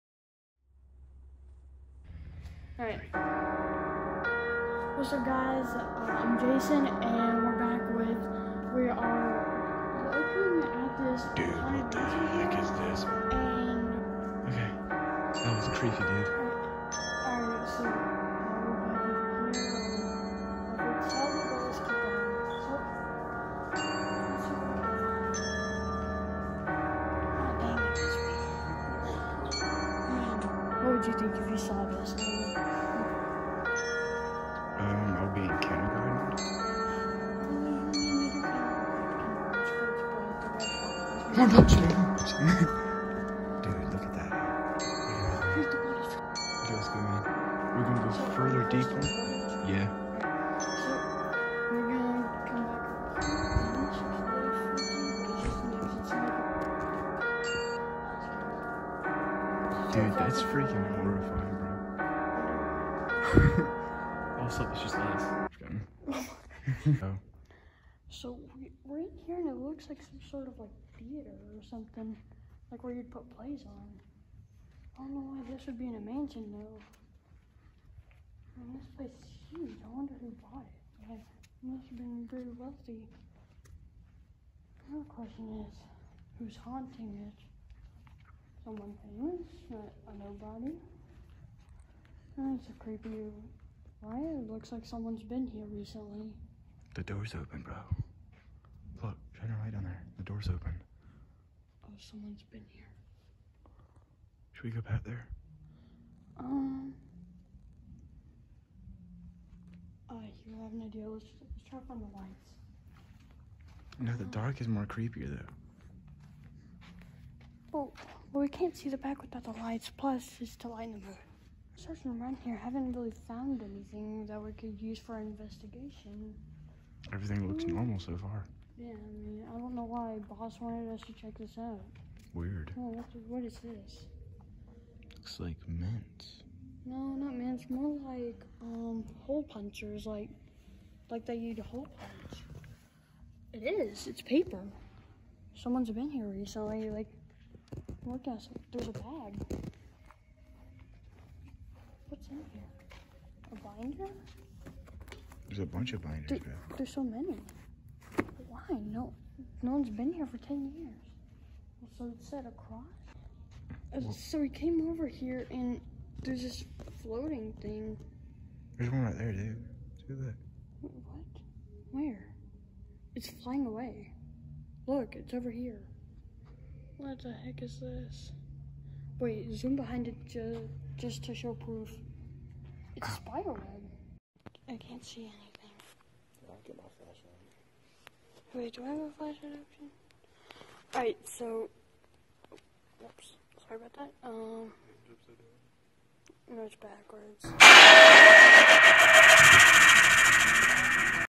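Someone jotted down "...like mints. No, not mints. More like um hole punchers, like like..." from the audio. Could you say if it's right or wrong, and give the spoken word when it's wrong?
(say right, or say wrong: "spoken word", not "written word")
right.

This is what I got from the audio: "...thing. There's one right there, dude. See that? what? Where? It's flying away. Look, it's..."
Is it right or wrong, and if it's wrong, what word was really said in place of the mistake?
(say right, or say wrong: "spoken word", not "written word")
right.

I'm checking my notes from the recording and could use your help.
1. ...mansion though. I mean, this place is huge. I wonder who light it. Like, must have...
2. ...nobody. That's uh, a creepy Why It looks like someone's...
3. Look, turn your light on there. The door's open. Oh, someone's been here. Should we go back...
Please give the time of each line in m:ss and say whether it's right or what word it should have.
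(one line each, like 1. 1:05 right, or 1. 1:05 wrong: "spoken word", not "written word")
1. 1:15 wrong: "bought", not "light"
2. 1:30 right
3. 1:39 right.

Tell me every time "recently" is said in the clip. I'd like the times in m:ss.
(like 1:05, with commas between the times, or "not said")
1:35, 2:26.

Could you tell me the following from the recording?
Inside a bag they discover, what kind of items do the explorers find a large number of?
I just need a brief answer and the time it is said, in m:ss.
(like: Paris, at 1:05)
Binders, at 2:36.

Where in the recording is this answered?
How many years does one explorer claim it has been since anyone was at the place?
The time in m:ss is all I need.
2:40.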